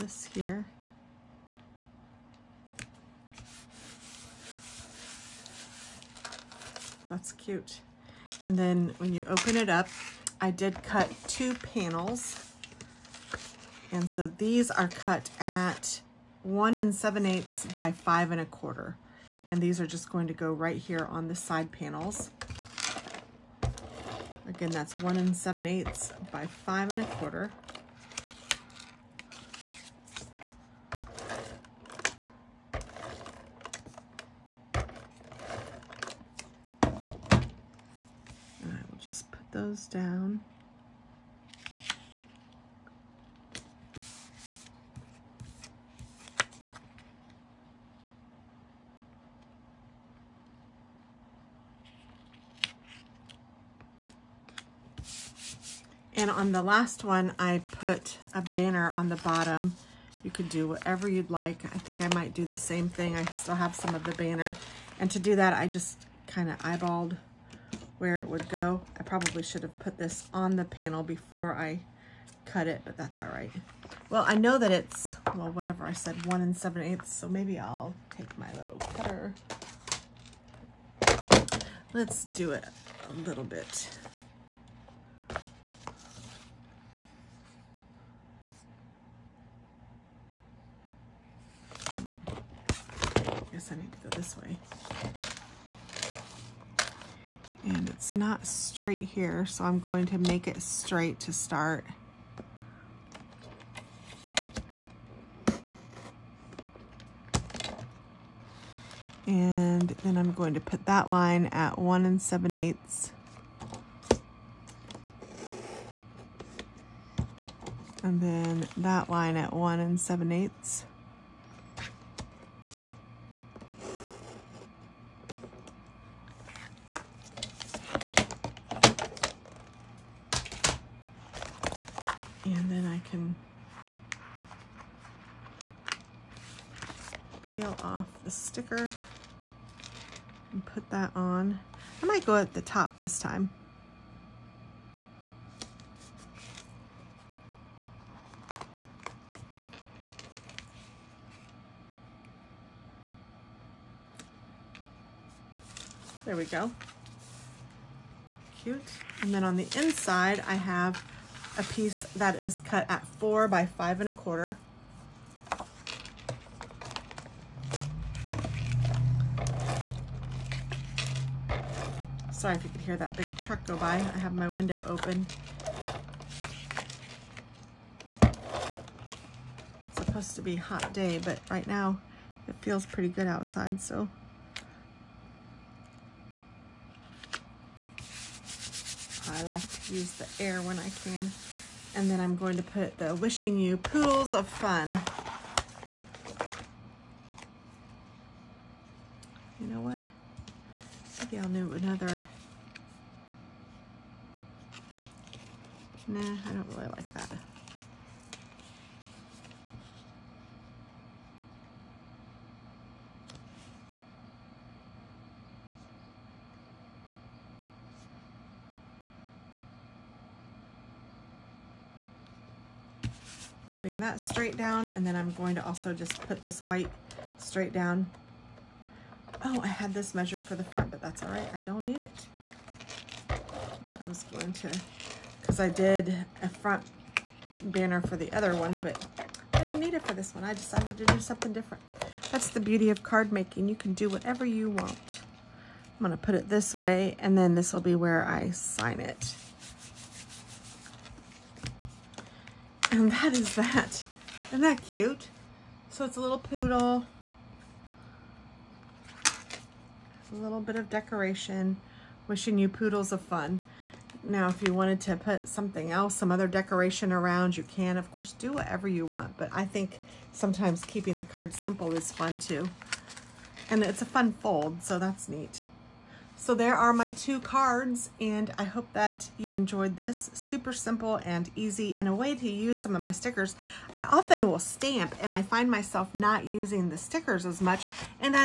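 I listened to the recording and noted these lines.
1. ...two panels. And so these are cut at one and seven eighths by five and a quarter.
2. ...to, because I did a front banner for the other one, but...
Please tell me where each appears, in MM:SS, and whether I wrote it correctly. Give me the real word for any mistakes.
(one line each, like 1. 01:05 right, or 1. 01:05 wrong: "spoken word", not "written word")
1. 00:11 right
2. 03:54 right.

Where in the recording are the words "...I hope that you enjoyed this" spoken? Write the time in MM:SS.
04:38.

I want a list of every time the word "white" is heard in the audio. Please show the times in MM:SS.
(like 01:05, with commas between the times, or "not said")
03:46.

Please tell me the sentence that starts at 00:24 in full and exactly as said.
Again, that's one and seven eighths by five and a quarter.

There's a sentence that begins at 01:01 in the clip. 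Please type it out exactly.
I think I might do the same thing.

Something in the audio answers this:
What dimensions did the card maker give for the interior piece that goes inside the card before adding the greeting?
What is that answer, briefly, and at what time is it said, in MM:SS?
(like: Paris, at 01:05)
4 by 5 1/4, at 02:43.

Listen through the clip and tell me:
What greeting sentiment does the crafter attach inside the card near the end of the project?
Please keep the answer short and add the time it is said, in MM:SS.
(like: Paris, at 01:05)
Wishing You Pools of Fun, at 03:13.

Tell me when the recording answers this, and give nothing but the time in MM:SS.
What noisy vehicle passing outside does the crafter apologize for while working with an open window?
02:53.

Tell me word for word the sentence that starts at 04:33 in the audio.
And it's a fun fold, so that's neat.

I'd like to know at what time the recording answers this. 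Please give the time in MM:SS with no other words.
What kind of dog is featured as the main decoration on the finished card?
04:16.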